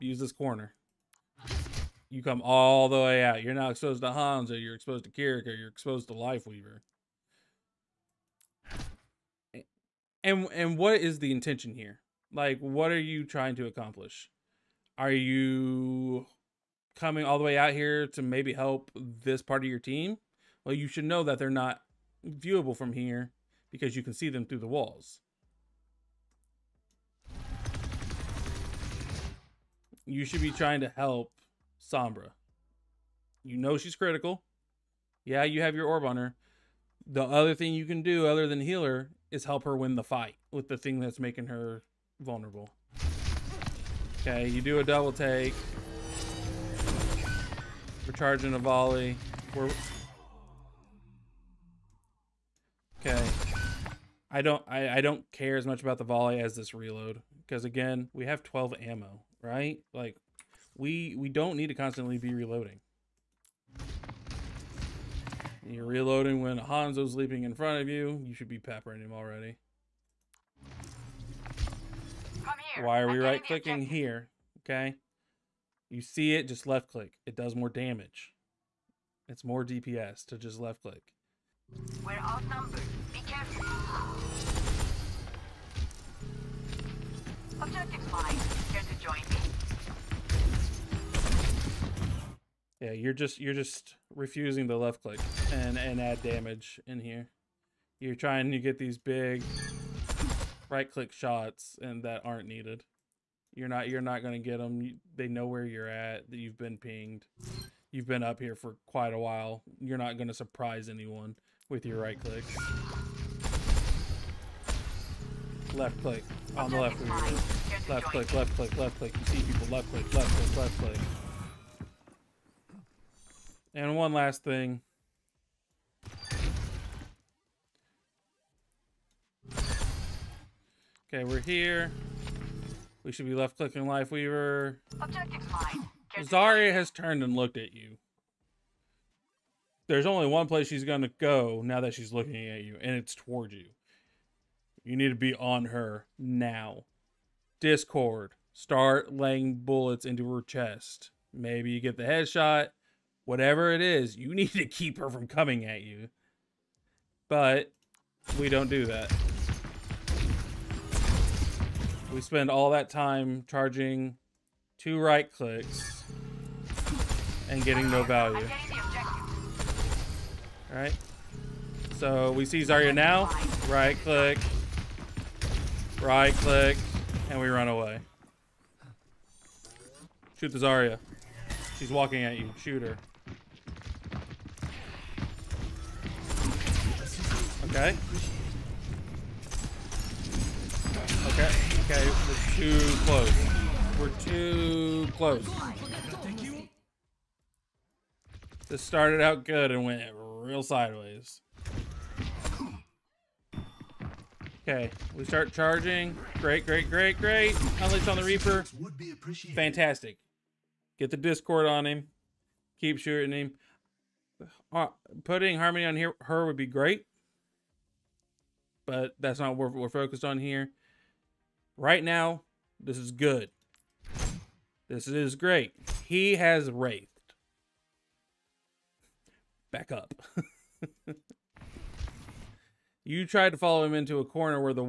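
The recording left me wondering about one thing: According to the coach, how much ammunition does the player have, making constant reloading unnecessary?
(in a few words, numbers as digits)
12.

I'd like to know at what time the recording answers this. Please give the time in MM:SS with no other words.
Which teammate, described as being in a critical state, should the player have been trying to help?
00:31.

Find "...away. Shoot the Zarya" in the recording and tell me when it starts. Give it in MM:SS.
02:57.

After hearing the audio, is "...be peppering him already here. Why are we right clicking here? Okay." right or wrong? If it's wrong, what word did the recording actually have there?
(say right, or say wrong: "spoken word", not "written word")
right.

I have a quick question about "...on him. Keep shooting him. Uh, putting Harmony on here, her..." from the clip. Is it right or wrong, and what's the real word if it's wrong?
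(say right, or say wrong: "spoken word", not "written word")
right.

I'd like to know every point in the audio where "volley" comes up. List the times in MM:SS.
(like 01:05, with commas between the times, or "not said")
00:48, 00:56.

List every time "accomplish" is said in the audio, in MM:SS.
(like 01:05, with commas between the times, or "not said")
00:13.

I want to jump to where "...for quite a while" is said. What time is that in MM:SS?
01:48.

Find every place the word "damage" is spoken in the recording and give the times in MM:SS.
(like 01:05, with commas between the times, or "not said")
01:17, 01:36.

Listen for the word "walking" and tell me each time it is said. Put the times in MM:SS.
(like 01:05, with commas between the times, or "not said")
03:01.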